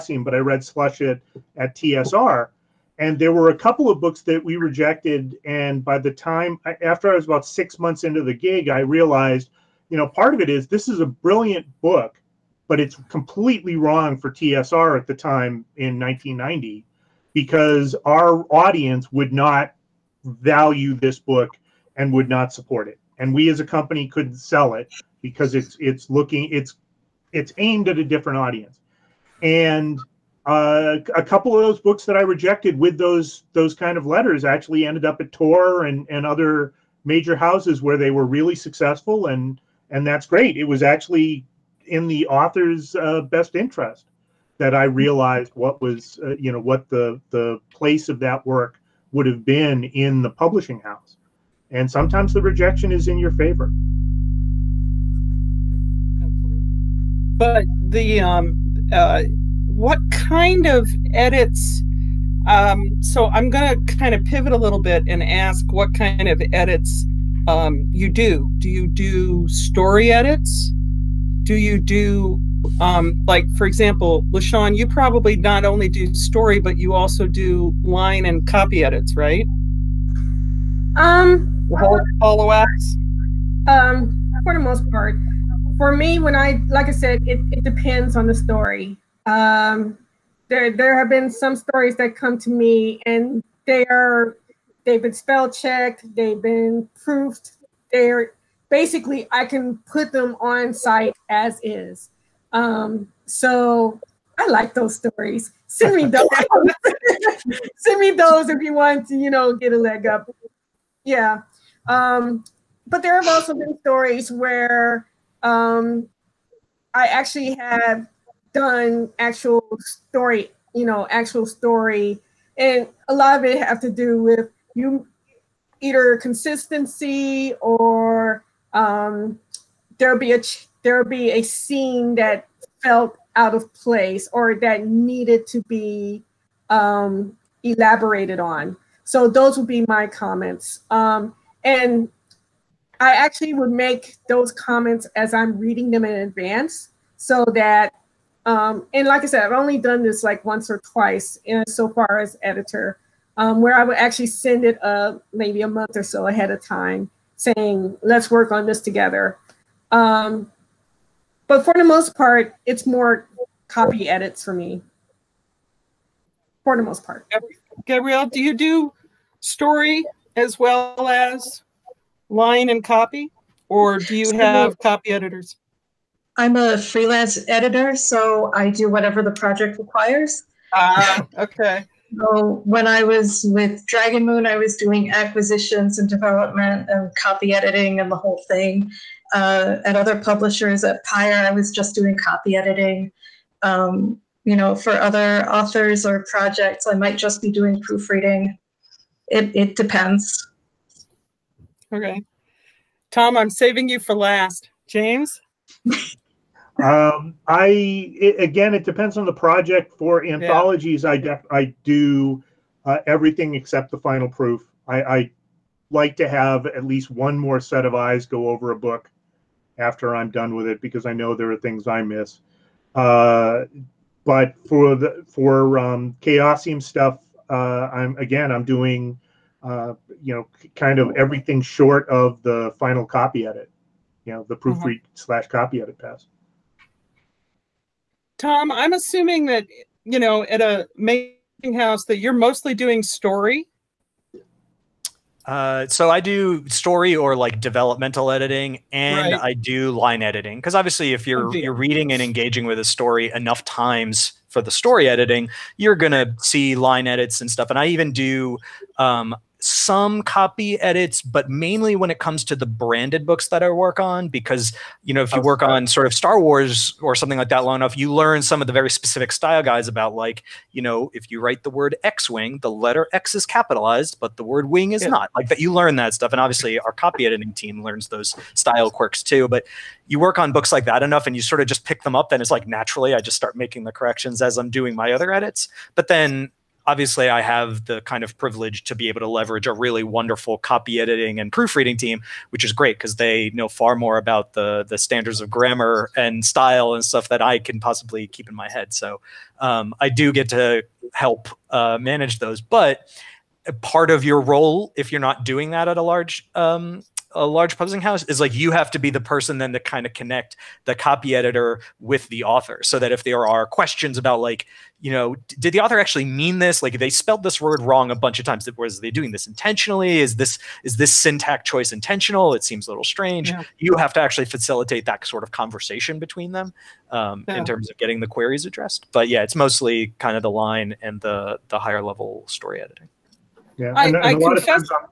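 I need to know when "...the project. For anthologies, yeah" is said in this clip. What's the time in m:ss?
3:29.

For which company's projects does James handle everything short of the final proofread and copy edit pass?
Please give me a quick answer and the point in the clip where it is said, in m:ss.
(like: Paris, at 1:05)
Chaosium, at 3:46.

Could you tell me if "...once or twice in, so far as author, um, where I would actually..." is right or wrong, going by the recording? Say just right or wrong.
wrong.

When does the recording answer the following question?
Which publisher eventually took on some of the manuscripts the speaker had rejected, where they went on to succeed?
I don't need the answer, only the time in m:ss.
0:35.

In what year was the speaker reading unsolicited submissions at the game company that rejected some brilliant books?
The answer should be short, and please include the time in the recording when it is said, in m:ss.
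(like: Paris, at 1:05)
1990, at 0:15.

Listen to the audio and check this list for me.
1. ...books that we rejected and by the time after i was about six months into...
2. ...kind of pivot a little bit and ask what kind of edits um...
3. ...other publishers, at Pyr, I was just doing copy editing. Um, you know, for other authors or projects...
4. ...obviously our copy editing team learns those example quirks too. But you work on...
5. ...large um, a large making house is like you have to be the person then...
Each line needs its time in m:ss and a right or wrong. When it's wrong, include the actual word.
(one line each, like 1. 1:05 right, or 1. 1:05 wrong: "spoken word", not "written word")
1. 0:03 right
2. 1:03 right
3. 3:09 right
4. 4:36 wrong: "style", not "example"
5. 5:06 wrong: "publishing", not "making".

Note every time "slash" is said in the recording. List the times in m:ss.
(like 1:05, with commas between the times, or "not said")
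3:55.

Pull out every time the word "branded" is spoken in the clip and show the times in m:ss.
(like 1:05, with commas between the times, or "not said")
4:22.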